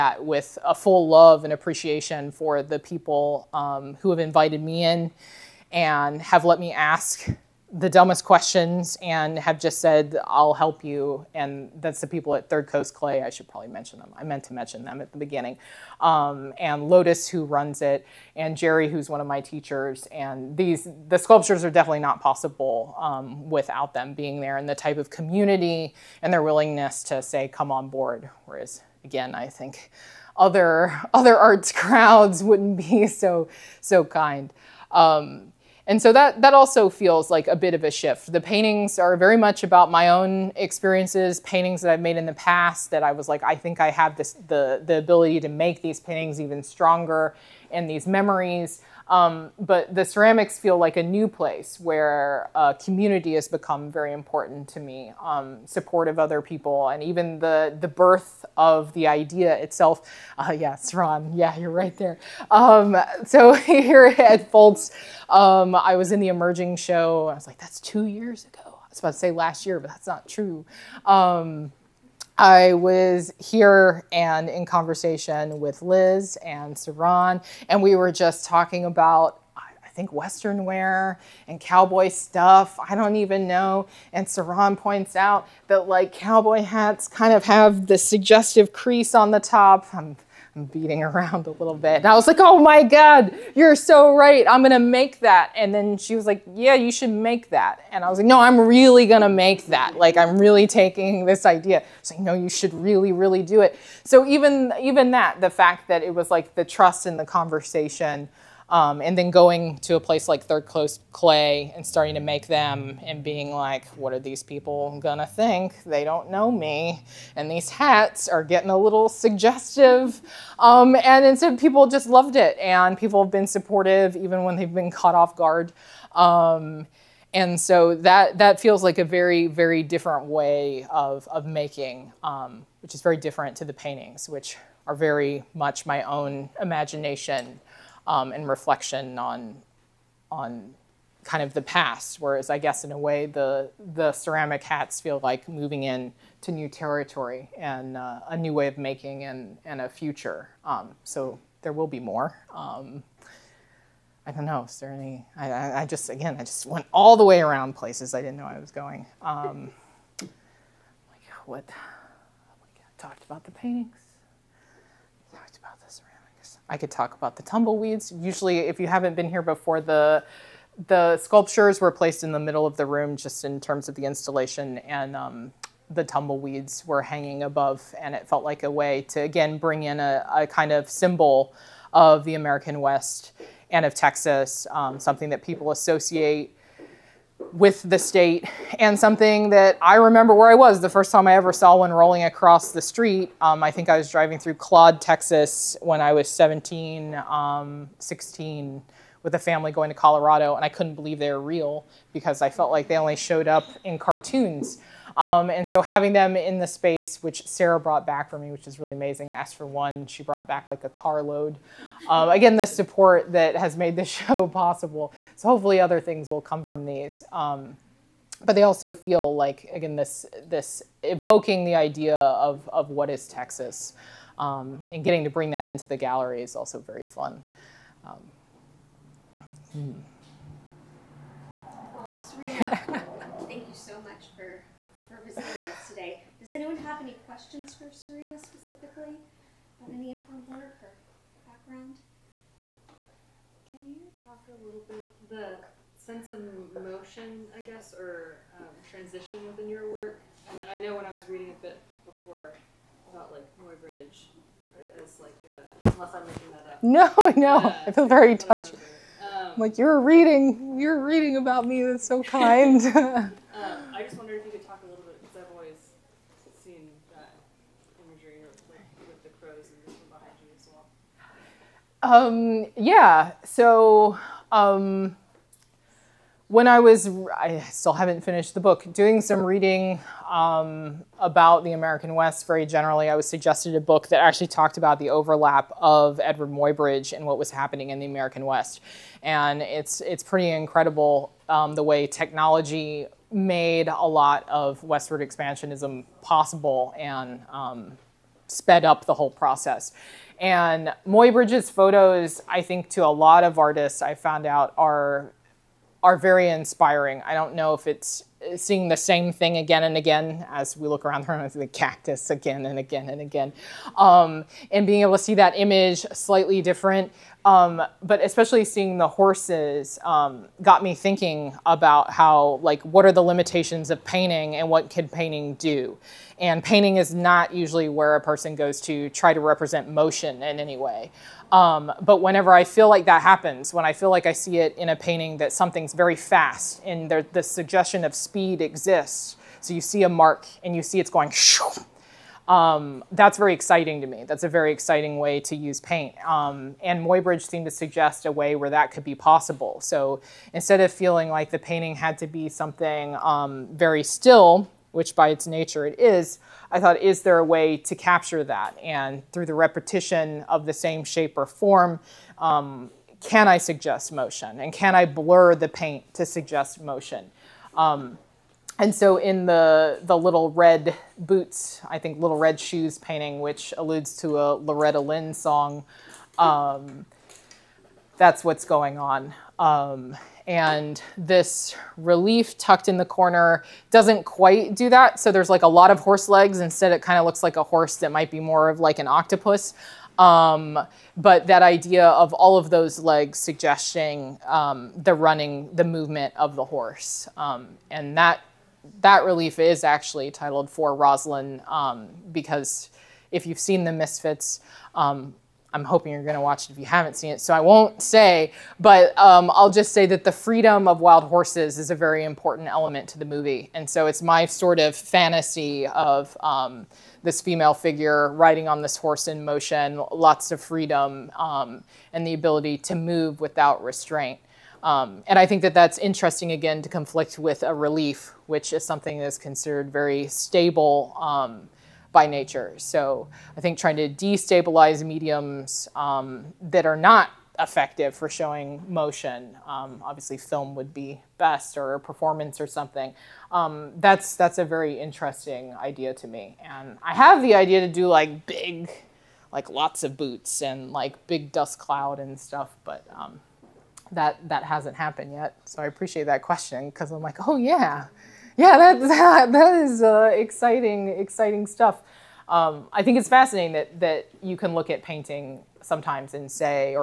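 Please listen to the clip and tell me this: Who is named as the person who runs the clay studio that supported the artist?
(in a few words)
Lotus.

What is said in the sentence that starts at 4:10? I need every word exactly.
And I know when I was reading a bit before about like Muybridge, as like uh, unless I'm making that up.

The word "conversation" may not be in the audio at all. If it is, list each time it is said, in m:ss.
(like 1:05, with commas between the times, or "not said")
1:14, 1:47.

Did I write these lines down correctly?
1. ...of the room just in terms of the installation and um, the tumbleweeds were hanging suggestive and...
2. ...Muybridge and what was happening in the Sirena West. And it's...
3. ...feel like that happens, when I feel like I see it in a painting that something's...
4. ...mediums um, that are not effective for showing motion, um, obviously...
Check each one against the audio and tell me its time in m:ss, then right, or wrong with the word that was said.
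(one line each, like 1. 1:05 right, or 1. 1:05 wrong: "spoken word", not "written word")
1. 2:52 wrong: "above", not "suggestive"
2. 4:46 wrong: "American", not "Sirena"
3. 5:32 right
4. 7:15 right.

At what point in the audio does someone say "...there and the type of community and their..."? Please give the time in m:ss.
0:24.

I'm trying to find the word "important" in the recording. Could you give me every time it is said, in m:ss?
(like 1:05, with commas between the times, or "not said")
0:54, 6:52.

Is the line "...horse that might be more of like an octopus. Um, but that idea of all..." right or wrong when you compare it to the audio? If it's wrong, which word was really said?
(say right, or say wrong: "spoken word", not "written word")
right.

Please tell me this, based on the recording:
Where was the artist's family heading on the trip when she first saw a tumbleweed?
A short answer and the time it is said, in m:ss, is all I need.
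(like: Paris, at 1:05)
Colorado, at 3:19.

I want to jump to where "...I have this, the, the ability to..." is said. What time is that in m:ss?
0:43.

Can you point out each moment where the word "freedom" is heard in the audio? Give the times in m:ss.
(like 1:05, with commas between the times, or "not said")
6:50, 7:00.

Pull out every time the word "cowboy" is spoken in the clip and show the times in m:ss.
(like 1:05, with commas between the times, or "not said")
1:21, 1:26.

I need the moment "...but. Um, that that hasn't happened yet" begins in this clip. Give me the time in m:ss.
7:32.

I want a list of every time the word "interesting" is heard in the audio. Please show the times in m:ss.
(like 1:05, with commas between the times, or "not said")
7:05, 7:24.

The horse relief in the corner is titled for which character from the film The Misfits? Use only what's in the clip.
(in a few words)
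Roslyn.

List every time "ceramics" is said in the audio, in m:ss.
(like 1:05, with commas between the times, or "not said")
0:50, 2:24.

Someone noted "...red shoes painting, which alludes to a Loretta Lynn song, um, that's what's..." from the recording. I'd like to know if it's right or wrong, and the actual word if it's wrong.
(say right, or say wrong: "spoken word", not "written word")
right.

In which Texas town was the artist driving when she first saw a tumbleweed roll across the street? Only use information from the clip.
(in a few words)
Claude, Texas.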